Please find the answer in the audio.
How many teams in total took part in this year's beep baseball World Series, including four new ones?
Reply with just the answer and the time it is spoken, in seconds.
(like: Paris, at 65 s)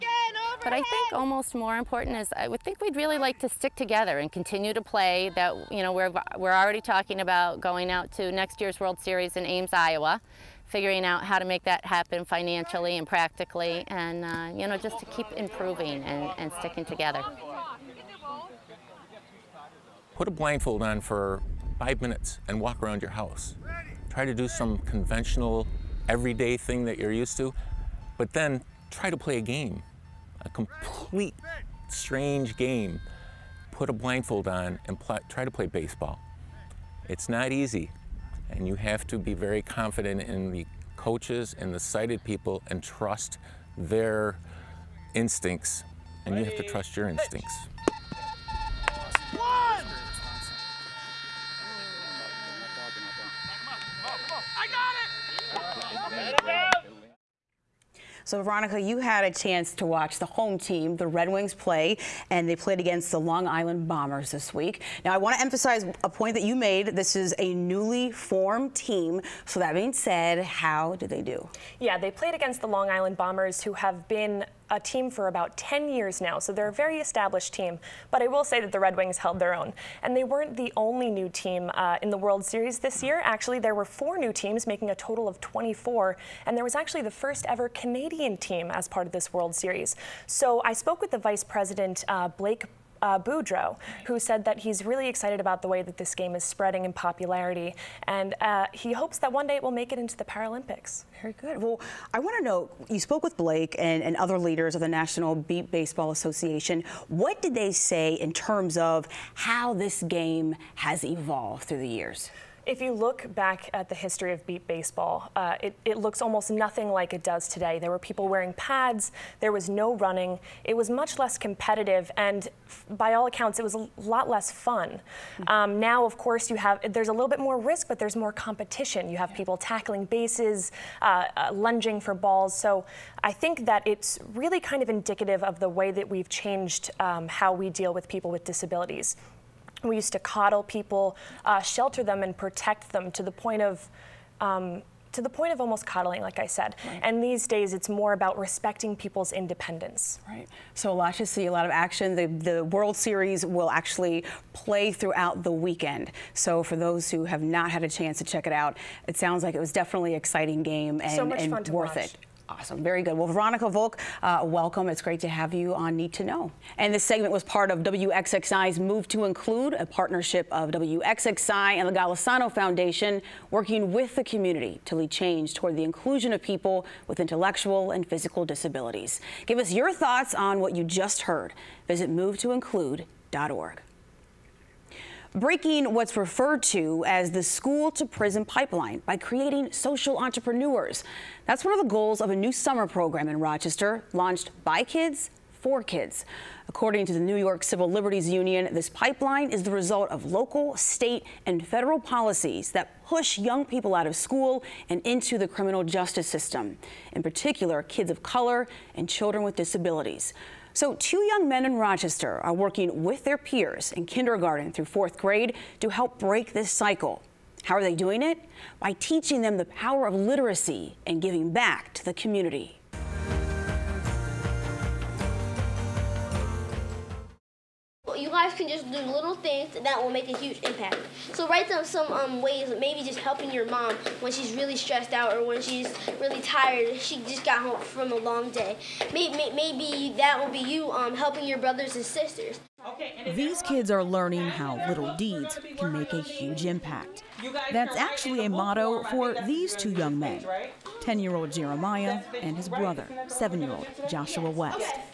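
24, at 85 s.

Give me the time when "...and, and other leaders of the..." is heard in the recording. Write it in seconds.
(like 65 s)
103 s.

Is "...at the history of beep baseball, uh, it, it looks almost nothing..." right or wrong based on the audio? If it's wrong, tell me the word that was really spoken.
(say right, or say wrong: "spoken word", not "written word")
right.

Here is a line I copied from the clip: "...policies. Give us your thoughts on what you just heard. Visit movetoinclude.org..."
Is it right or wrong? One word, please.
wrong.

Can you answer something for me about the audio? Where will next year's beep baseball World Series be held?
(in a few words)
Ames, Iowa.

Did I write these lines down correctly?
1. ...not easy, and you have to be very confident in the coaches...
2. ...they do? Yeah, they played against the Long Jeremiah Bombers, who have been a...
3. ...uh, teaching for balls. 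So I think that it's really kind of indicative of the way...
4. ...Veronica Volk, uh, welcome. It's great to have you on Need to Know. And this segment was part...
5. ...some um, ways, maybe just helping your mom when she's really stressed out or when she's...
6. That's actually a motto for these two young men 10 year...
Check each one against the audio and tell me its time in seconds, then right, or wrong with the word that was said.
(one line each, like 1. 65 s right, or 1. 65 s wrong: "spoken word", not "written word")
1. 37 s right
2. 71 s wrong: "Island", not "Jeremiah"
3. 131 s wrong: "lunging", not "teaching"
4. 163 s right
5. 231 s right
6. 247 s right.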